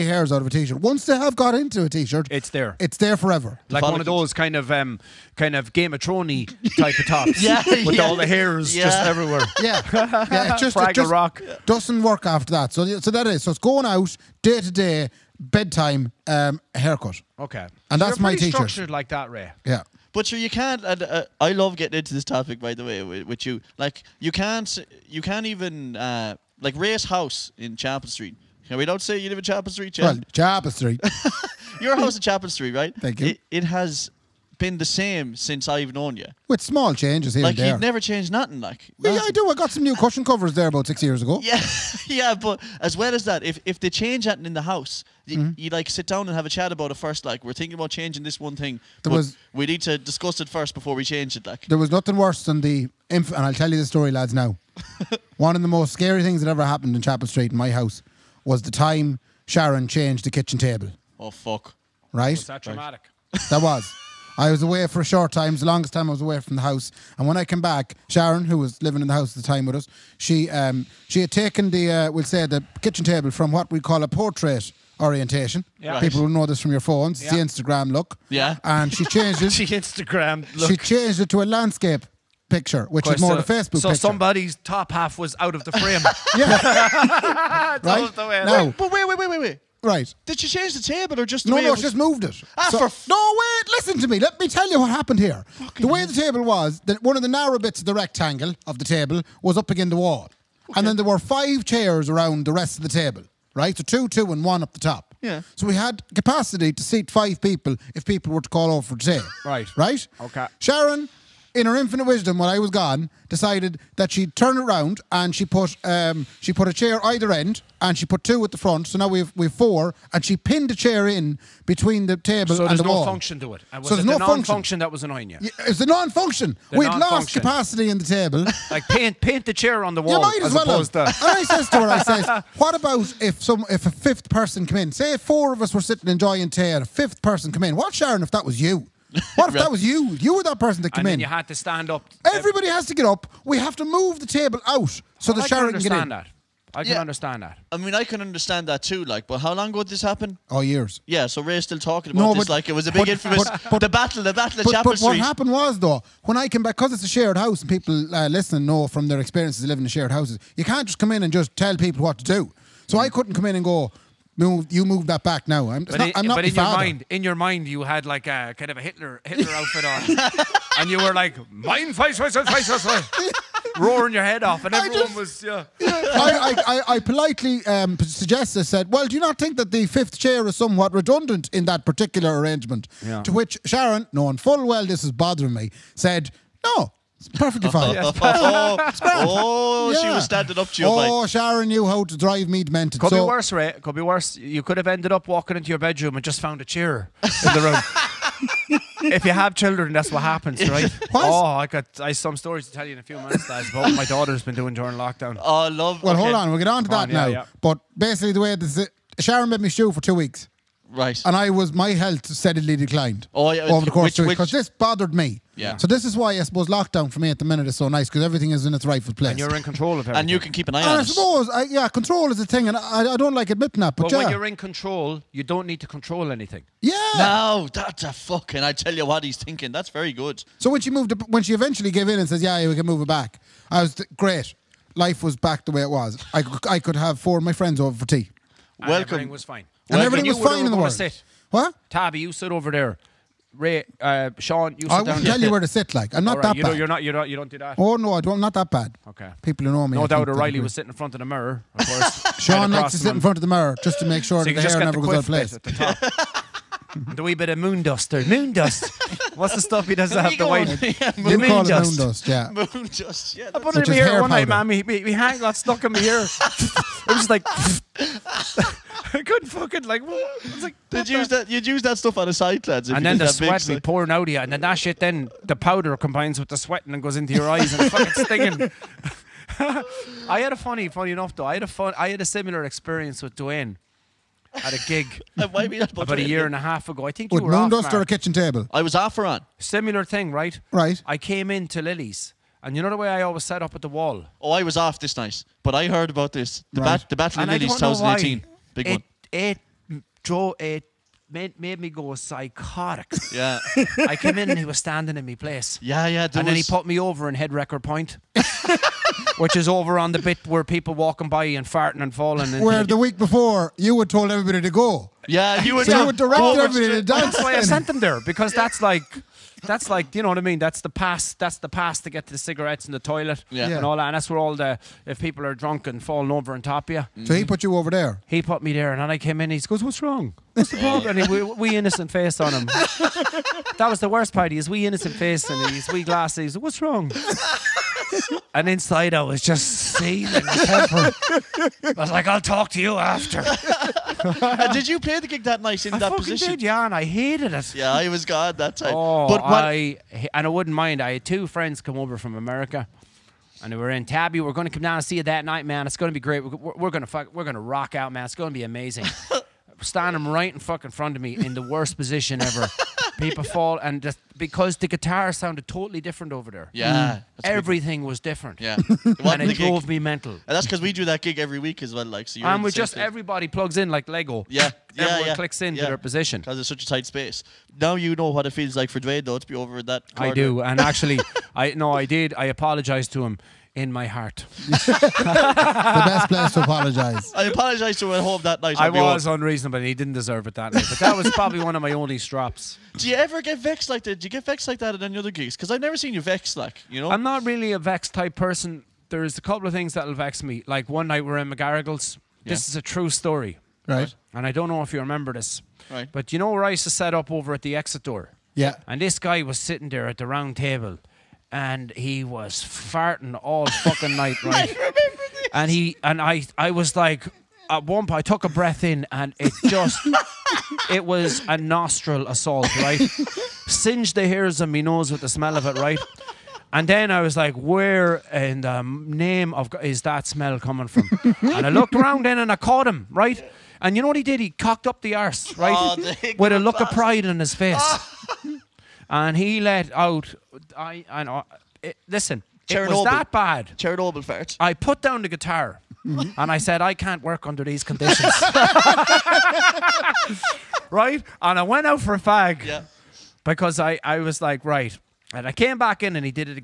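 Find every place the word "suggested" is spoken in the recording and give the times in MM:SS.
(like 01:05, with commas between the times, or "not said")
02:57.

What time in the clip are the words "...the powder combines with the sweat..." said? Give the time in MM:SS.
04:35.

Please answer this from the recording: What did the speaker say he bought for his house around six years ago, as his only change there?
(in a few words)
cushion covers.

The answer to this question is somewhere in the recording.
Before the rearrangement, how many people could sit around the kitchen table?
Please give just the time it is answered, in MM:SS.
01:47.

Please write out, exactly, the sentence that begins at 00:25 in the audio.
Uh, like Ray's house in Chapel Street.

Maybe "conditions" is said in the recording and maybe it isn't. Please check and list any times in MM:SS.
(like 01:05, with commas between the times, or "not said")
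07:27.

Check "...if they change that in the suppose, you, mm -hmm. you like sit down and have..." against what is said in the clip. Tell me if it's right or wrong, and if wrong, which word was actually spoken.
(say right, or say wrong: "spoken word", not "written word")
wrong: "house", not "suppose".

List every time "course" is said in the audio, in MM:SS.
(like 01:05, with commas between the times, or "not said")
03:33, 04:11.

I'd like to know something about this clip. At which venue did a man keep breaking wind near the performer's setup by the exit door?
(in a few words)
McGarrigles.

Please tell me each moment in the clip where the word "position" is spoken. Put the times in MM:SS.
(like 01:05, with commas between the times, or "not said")
05:46, 06:01, 06:15.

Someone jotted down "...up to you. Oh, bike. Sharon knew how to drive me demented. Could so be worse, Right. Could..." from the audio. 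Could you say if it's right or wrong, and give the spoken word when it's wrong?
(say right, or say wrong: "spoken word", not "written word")
wrong: "Ray", not "Right".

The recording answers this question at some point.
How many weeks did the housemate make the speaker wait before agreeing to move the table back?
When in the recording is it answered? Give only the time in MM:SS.
03:29.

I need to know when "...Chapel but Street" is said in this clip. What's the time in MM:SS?
02:34.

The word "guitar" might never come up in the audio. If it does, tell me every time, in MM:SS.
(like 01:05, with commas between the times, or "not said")
06:04, 07:25.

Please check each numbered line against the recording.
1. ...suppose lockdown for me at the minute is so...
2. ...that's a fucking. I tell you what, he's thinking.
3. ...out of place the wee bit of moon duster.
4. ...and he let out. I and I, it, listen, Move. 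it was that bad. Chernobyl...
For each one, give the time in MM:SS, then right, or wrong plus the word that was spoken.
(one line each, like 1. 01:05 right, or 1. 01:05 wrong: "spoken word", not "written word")
1. 03:36 right
2. 03:47 right
3. 04:15 right
4. 07:19 wrong: "Chernobyl", not "Move".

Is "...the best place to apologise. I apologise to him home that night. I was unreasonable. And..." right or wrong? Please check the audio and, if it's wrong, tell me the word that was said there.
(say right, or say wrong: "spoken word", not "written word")
right.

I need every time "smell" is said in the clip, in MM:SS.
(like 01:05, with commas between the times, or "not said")
07:05, 07:10.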